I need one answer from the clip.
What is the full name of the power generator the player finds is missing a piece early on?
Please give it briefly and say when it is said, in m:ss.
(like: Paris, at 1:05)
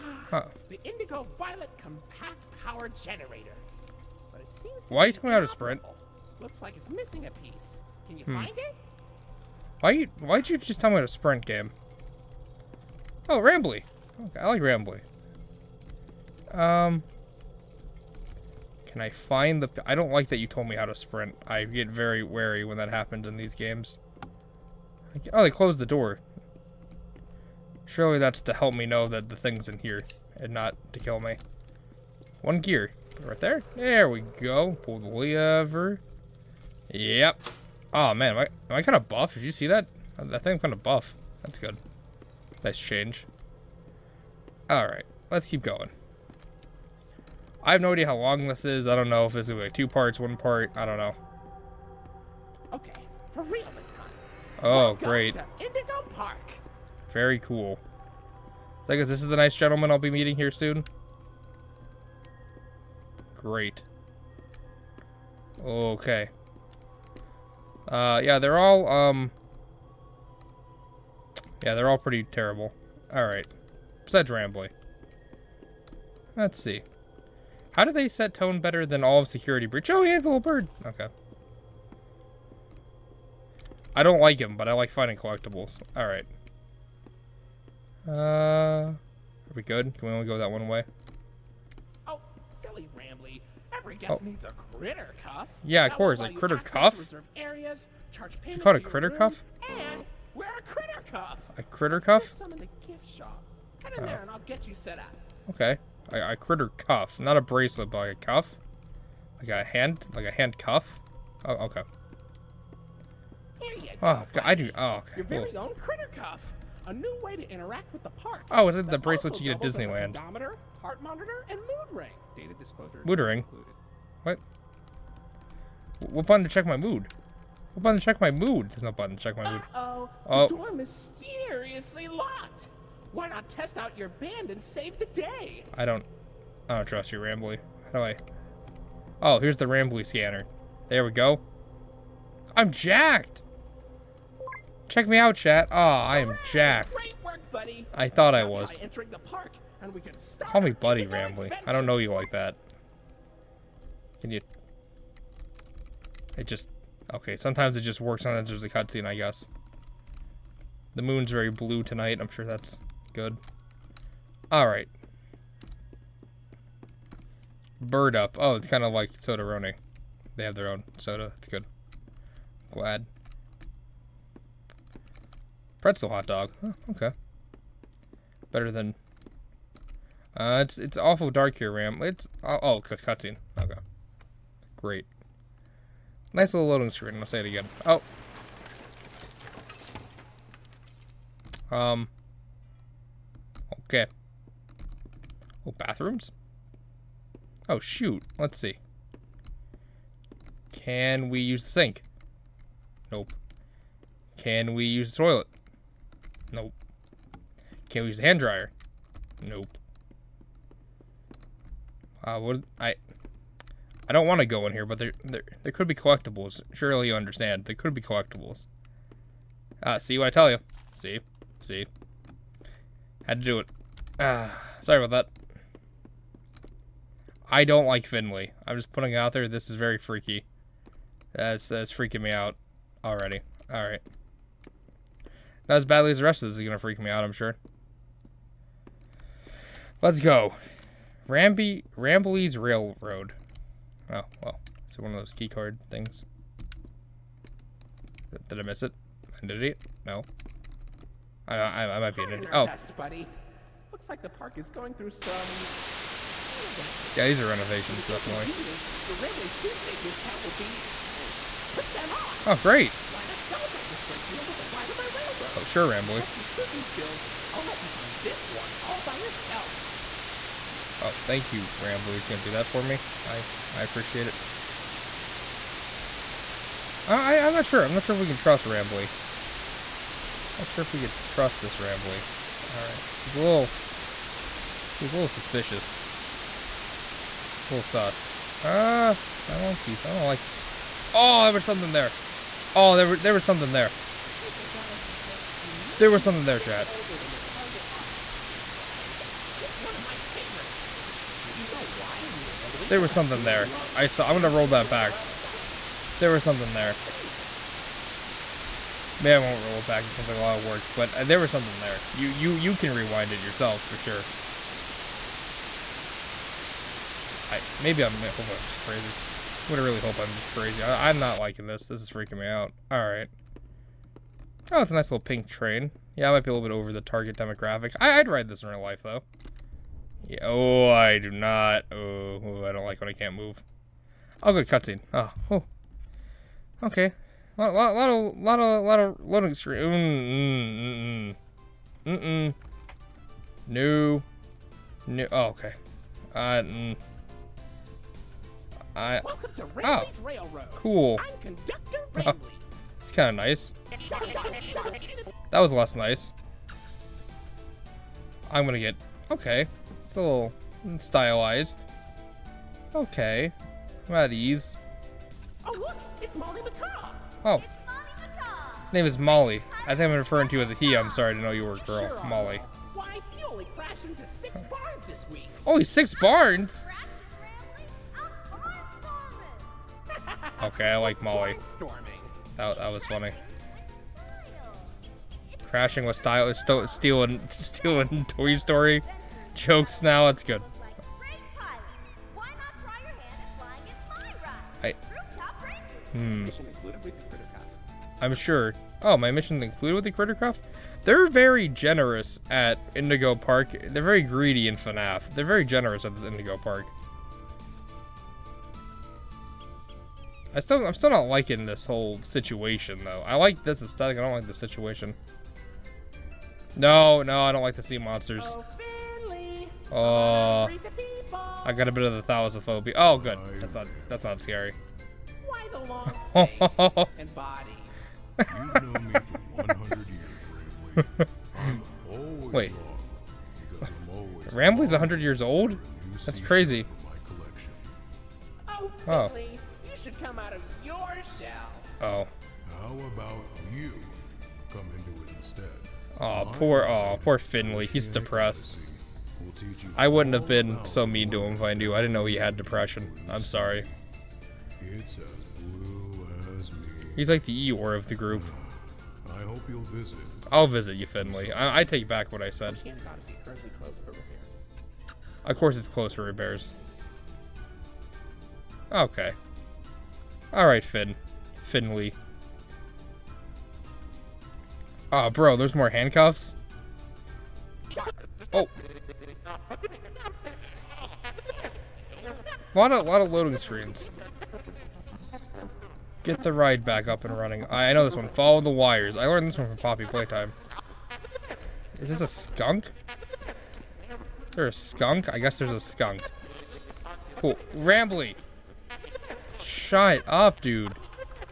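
Indigo Violet Compact Power Generator, at 0:00.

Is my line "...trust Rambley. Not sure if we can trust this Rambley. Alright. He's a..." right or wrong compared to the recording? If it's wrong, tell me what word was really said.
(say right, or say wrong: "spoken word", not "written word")
right.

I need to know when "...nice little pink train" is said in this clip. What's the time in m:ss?
5:24.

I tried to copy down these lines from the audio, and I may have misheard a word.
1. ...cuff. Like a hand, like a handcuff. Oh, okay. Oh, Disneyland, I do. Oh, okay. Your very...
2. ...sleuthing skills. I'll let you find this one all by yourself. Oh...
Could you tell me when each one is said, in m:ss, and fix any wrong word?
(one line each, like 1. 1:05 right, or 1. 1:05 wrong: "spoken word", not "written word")
1. 1:48 wrong: "God", not "Disneyland"
2. 4:26 right.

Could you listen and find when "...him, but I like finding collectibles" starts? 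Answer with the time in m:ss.
1:24.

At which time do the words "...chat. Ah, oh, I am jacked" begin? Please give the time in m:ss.
2:25.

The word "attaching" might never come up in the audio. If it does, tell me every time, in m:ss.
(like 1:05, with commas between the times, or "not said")
not said.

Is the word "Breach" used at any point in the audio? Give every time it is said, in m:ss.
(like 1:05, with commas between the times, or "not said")
1:19.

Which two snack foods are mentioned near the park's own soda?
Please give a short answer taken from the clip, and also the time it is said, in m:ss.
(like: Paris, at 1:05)
Pretzel hot dog, at 2:55.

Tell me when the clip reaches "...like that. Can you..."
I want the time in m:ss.
2:32.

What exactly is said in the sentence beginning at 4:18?
Convenience, your Rambley Tuesday discount will be free.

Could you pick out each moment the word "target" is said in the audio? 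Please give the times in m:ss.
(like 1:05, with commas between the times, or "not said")
4:57, 5:27.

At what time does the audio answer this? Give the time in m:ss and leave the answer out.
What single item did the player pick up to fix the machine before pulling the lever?
0:32.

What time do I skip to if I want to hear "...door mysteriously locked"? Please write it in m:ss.
2:10.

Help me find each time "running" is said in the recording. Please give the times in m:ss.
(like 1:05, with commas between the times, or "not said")
2:49, 8:07.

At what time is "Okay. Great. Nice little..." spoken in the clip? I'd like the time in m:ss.
3:03.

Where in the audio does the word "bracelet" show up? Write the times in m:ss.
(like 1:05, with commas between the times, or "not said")
1:47, 1:58.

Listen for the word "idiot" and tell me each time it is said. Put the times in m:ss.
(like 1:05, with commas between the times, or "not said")
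4:12.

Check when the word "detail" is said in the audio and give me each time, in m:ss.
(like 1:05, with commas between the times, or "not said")
not said.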